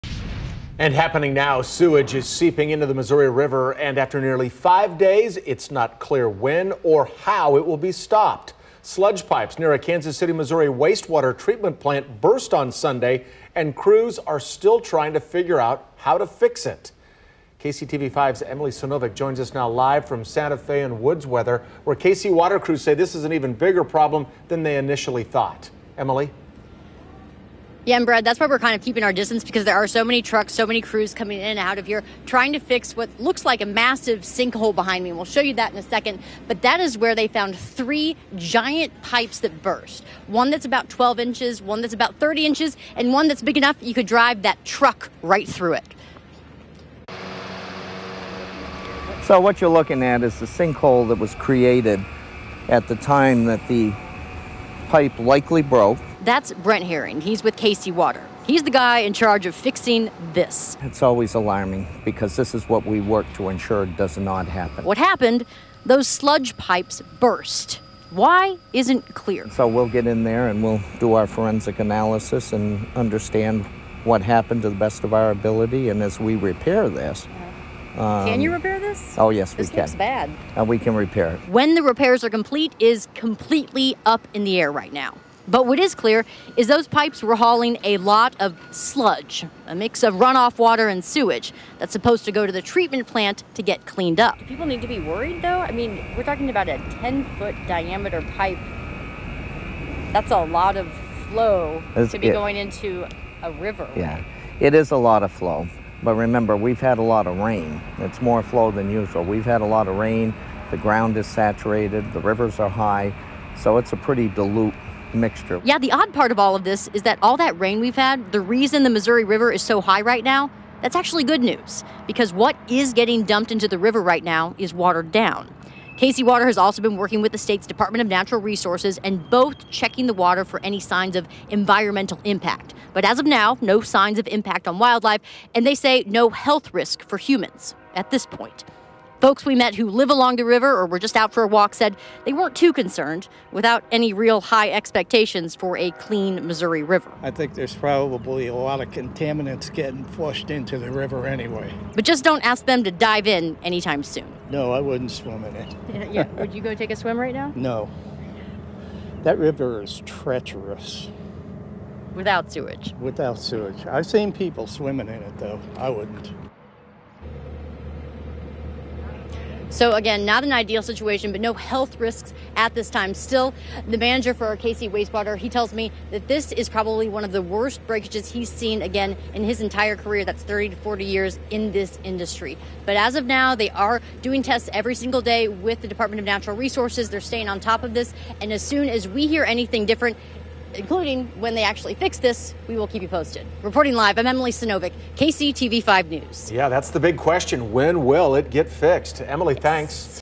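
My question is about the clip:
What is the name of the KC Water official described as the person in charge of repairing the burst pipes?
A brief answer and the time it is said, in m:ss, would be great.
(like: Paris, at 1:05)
Brent Herring, at 0:56.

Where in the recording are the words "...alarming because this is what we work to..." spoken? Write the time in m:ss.
1:01.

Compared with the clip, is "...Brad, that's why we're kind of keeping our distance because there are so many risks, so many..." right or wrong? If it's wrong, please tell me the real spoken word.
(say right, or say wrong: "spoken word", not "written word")
wrong: "trucks", not "risks".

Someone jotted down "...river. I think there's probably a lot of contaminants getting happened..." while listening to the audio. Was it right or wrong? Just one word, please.
wrong.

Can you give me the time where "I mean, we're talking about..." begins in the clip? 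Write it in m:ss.
1:35.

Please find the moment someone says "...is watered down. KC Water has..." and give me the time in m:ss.
2:04.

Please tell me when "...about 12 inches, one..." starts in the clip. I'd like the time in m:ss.
0:40.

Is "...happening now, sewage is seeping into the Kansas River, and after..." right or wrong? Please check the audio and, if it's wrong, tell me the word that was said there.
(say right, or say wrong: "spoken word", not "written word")
wrong: "Missouri", not "Kansas".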